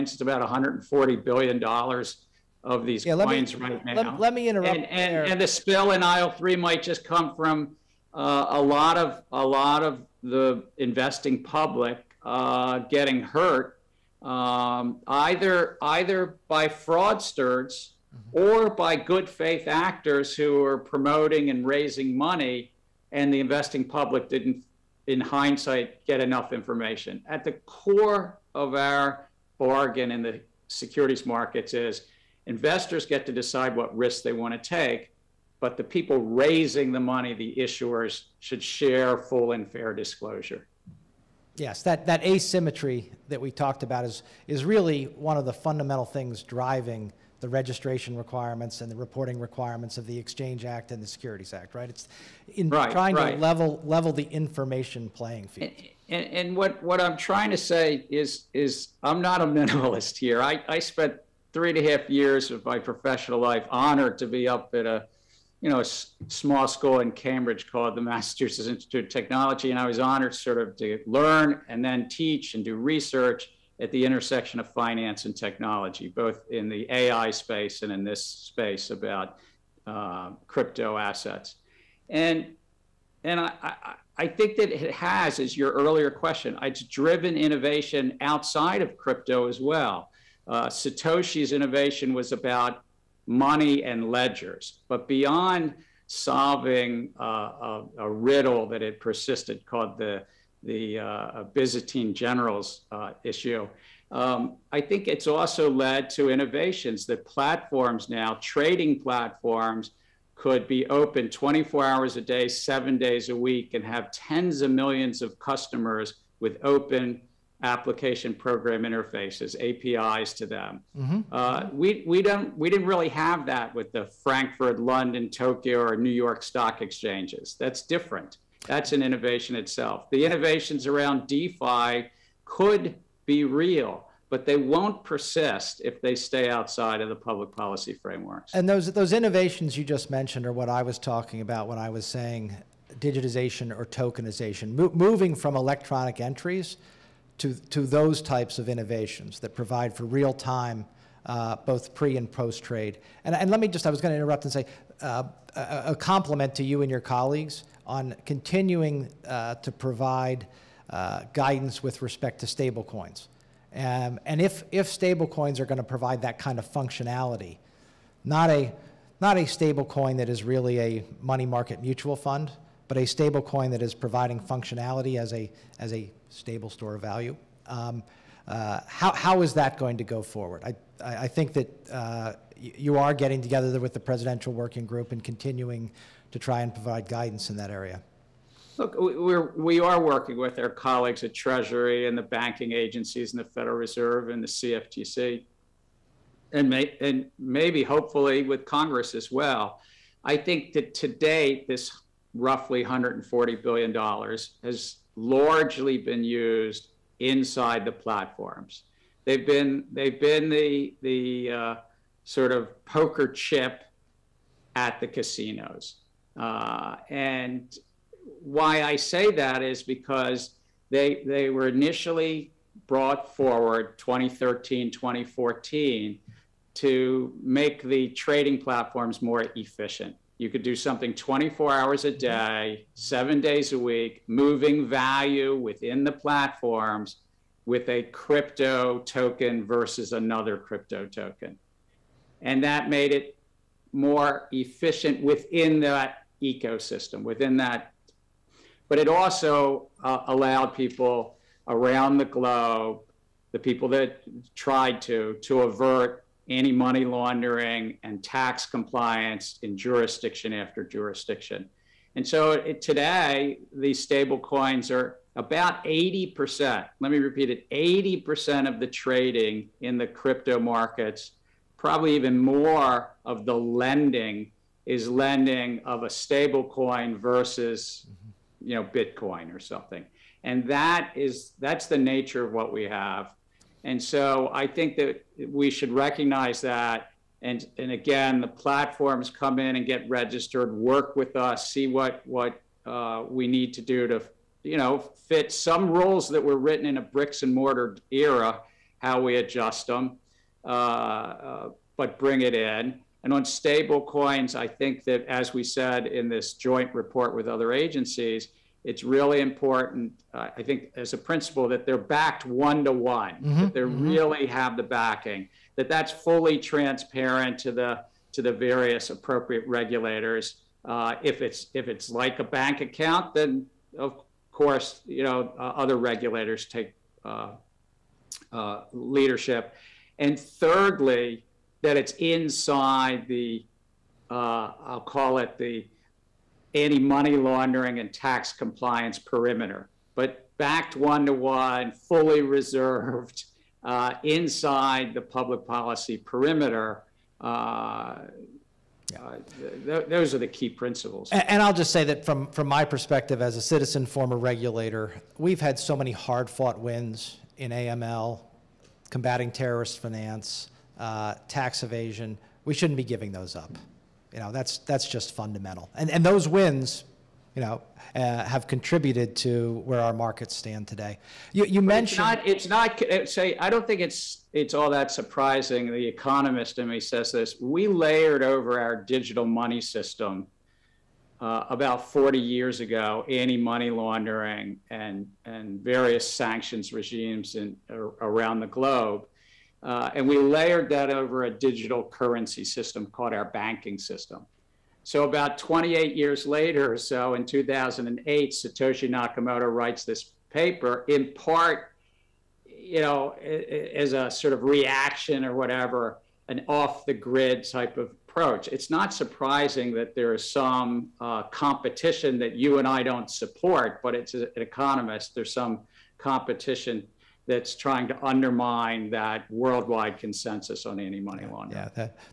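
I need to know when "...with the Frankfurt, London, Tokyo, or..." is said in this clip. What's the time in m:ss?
2:03.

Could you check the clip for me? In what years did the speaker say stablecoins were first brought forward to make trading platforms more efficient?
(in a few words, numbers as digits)
2013-2014.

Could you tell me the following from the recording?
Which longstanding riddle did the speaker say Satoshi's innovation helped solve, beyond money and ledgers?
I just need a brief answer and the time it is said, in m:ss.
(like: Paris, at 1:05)
Byzantine generals, at 1:41.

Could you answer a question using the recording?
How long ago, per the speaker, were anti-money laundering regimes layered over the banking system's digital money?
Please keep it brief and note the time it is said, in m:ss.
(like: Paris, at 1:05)
about 40 years, at 6:21.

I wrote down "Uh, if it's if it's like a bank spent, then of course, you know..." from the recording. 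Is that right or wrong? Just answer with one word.
wrong.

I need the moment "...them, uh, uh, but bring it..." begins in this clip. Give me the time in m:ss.
4:59.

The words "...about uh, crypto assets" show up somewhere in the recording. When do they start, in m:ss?
1:18.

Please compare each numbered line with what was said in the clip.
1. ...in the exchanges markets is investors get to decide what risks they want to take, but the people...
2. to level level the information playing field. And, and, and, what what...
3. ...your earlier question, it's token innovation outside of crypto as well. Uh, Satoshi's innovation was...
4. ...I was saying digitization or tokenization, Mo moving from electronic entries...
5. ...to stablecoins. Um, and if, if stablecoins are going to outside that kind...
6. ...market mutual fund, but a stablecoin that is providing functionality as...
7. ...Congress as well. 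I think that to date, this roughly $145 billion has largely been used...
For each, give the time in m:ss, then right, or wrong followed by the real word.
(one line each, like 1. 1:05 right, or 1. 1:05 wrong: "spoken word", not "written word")
1. 0:30 wrong: "securities", not "exchanges"
2. 0:53 right
3. 1:25 wrong: "driven", not "token"
4. 2:21 right
5. 2:42 wrong: "provide", not "outside"
6. 2:51 right
7. 3:18 wrong: "140", not "145".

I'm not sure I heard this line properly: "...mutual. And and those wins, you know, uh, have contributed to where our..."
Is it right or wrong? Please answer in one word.
wrong.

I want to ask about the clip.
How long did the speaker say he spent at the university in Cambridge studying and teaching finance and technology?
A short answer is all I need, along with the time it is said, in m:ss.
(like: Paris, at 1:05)
3.5 years, at 1:01.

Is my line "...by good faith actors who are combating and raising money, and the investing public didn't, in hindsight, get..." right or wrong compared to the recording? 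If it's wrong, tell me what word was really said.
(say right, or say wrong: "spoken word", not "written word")
wrong: "promoting", not "combating".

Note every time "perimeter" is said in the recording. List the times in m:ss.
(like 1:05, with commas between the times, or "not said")
5:39, 5:46.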